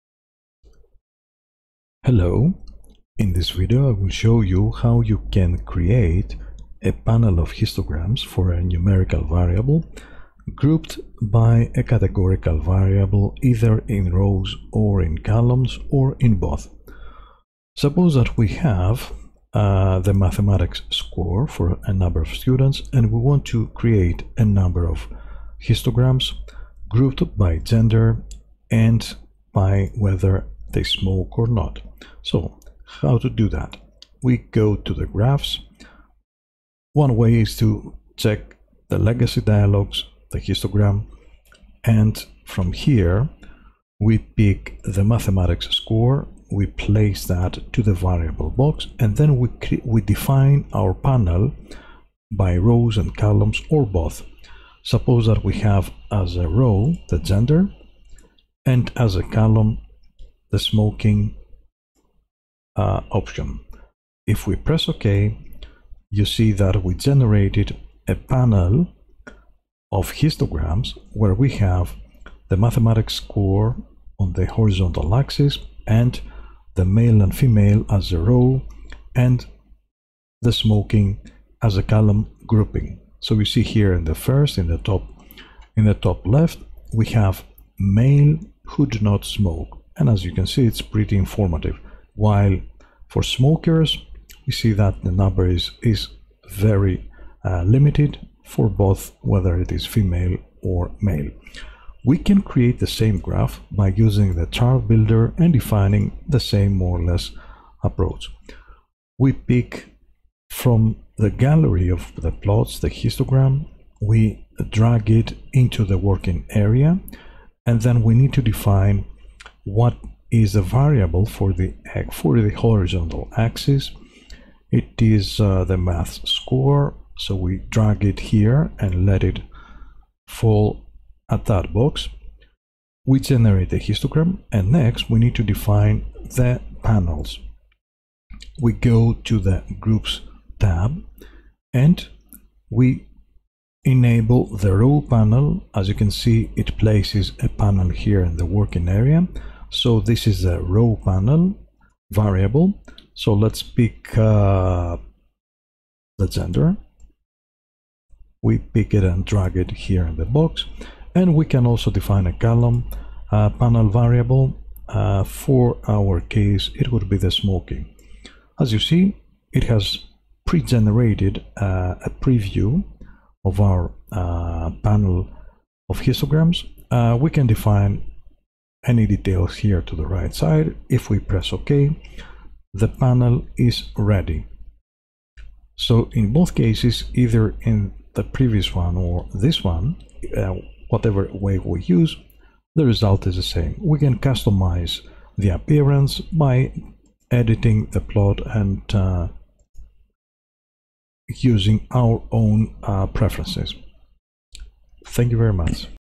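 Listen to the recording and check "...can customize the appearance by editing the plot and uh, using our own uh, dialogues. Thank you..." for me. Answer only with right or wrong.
wrong.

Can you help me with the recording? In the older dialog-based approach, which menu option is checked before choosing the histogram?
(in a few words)
Legacy dialogues.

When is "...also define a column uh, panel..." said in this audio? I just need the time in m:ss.
2:41.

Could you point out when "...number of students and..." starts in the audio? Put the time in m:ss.
0:21.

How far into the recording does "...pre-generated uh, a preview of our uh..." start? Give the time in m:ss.
2:50.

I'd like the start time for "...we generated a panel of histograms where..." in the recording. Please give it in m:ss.
1:06.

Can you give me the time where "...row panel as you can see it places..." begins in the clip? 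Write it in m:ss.
2:24.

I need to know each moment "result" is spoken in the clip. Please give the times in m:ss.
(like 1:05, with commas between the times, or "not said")
3:12.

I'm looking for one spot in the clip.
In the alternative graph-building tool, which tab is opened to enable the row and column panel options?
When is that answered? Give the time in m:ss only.
2:19.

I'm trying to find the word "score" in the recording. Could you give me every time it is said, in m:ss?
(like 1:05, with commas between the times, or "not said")
0:20, 0:45, 1:13, 2:06.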